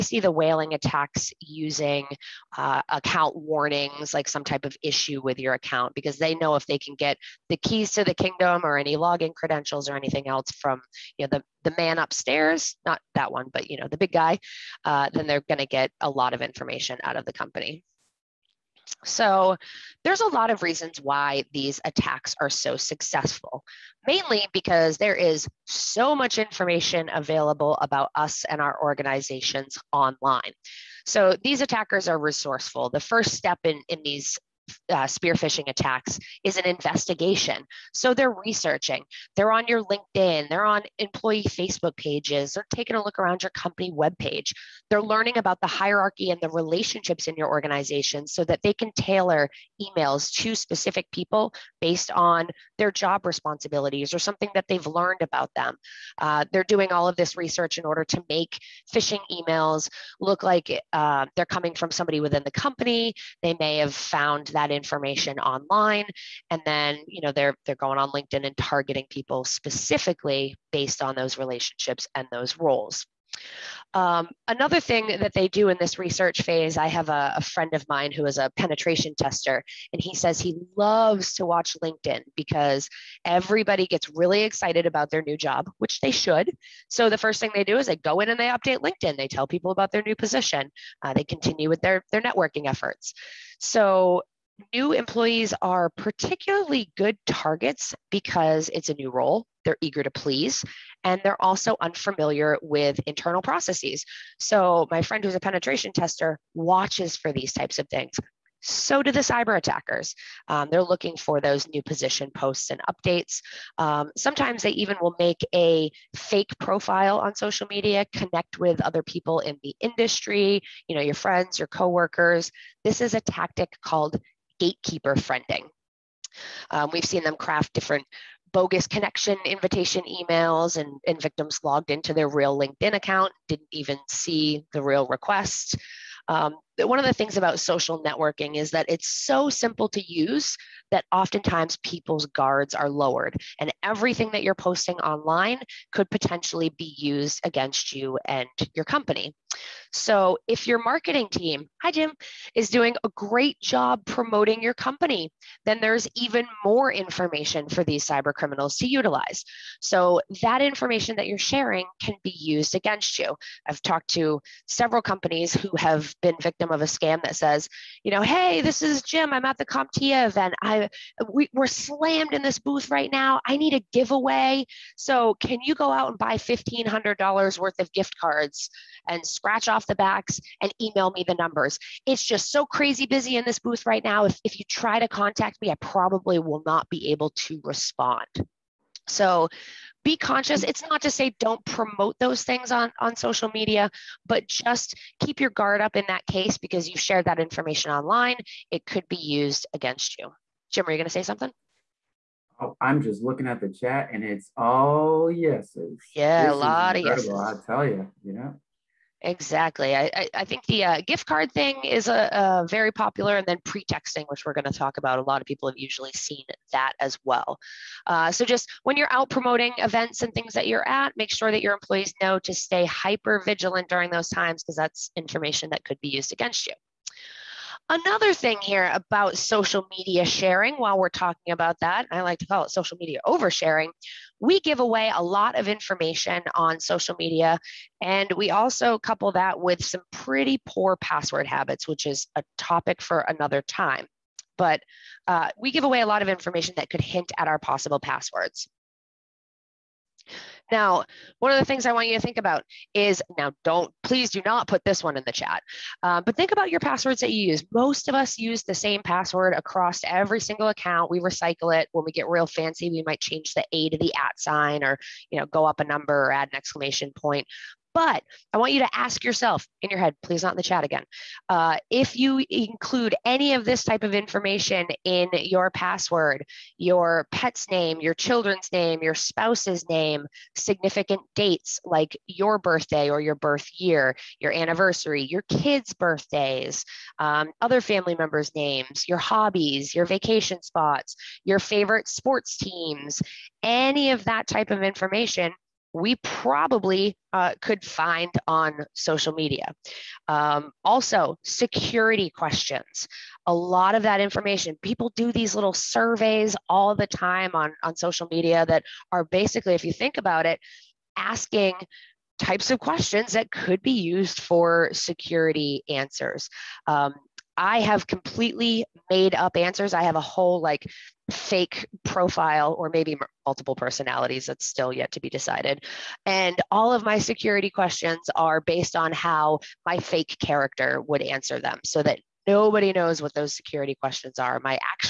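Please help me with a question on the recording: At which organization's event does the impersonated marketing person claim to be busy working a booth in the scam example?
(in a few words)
CompTIA.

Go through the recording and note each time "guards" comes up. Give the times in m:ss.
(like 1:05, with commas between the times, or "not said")
2:22, 3:15.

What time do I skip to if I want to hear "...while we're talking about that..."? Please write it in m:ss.
3:50.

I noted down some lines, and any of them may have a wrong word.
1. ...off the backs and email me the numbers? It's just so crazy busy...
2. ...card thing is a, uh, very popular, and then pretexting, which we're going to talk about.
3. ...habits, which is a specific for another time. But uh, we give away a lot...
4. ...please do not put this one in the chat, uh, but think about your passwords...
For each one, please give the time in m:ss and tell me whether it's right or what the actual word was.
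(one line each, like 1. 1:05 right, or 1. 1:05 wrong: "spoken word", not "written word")
1. 2:59 right
2. 3:31 right
3. 4:01 wrong: "topic", not "specific"
4. 4:14 right.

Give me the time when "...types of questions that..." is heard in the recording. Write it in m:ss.
5:12.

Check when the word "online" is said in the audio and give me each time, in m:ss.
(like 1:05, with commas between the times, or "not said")
0:29, 1:05, 2:24, 3:17.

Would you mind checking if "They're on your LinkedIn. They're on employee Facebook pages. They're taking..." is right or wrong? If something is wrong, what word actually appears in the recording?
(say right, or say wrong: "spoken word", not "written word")
right.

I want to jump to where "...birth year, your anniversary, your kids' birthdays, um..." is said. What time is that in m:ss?
4:43.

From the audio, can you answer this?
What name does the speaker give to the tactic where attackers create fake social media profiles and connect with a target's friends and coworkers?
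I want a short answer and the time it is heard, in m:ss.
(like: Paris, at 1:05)
Gatekeeper friending, at 2:04.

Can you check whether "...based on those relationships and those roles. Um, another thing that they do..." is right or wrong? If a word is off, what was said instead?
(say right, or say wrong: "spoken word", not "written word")
right.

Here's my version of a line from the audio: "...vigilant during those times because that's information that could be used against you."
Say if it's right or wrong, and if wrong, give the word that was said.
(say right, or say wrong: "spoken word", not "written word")
right.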